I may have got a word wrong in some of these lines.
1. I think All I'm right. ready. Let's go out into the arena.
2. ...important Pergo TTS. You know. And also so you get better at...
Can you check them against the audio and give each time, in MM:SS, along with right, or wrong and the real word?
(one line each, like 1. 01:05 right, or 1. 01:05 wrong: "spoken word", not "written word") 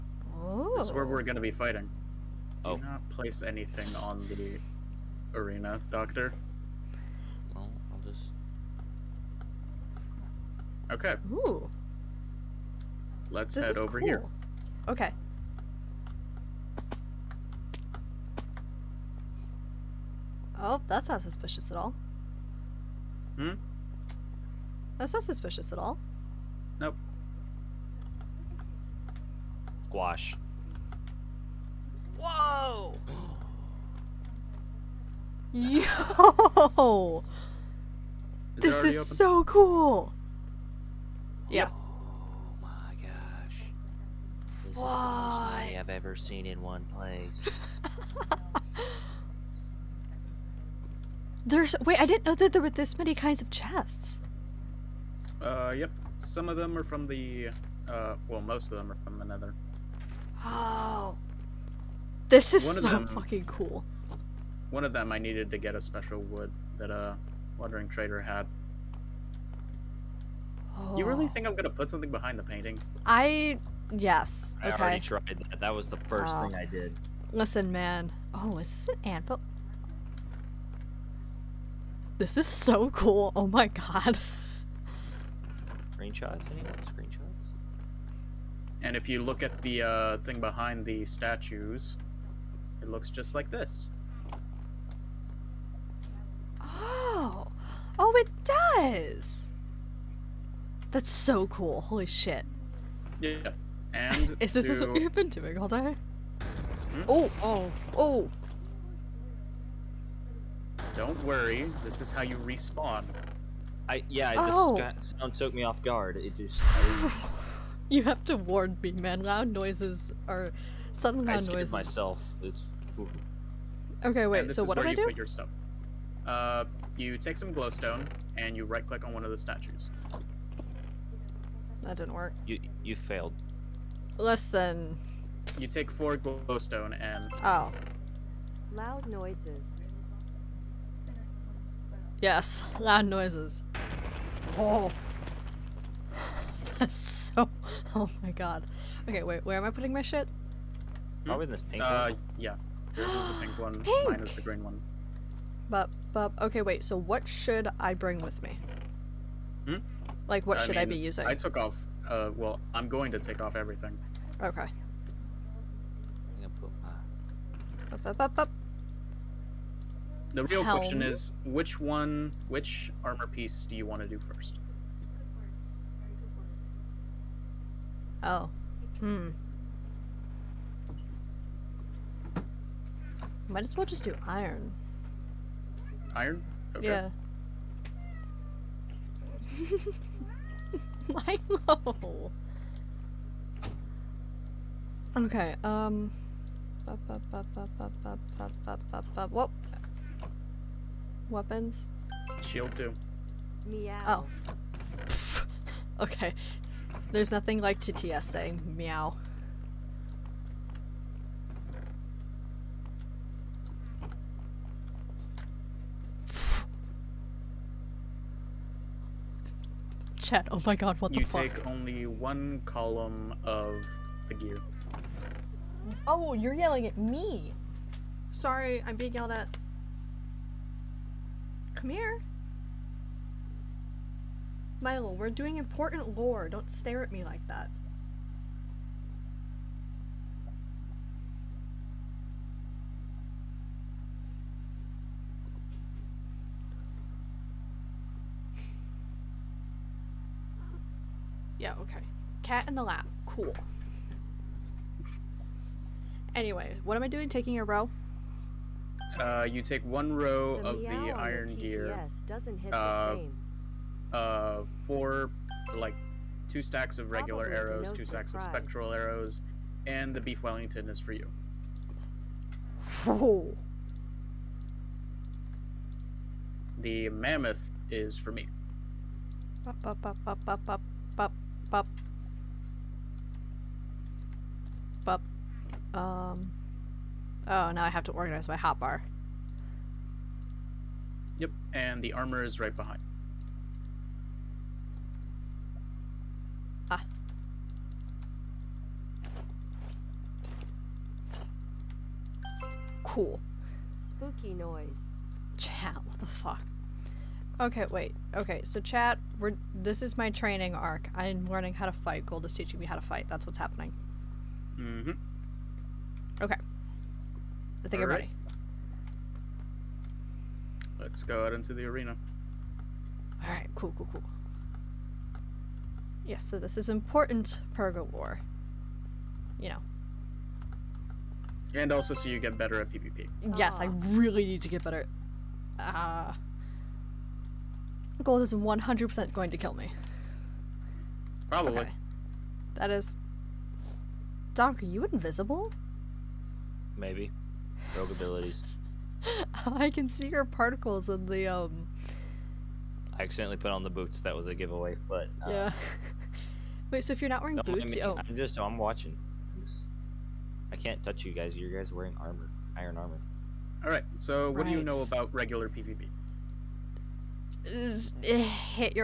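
1. 05:17 right
2. 05:26 wrong: "War", not "TTS".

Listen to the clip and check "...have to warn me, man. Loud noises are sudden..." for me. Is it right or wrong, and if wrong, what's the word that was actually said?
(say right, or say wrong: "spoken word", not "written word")
right.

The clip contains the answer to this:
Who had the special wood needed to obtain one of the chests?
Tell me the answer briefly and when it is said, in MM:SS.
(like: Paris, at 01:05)
A wandering trader, at 01:07.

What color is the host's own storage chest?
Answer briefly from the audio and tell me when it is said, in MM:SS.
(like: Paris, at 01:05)
Green, at 02:34.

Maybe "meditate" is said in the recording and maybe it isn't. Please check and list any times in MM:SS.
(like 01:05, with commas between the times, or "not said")
not said.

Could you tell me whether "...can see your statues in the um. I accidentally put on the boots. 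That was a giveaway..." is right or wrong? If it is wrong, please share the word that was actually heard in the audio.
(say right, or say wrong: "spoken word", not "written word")
wrong: "particles", not "statues".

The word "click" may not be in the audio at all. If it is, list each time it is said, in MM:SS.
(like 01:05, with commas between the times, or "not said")
02:08.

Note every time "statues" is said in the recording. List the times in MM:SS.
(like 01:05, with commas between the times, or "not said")
01:31, 02:09.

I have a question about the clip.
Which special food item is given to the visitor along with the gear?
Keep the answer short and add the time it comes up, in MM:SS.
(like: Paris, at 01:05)
Beef Wellington, at 04:30.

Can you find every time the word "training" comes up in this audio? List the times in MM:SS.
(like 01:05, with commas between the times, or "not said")
05:10.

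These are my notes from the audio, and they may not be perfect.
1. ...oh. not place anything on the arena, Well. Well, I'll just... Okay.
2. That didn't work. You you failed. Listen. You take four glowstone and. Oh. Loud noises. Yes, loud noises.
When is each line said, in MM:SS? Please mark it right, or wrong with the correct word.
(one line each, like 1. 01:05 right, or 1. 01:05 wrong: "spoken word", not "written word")
1. 00:02 wrong: "Doctor", not "Well"
2. 02:11 right.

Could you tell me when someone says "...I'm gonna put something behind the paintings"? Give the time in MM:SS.
01:11.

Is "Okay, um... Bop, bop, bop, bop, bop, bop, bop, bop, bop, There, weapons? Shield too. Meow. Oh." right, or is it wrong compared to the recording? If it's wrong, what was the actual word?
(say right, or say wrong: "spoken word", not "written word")
wrong: "Well", not "There".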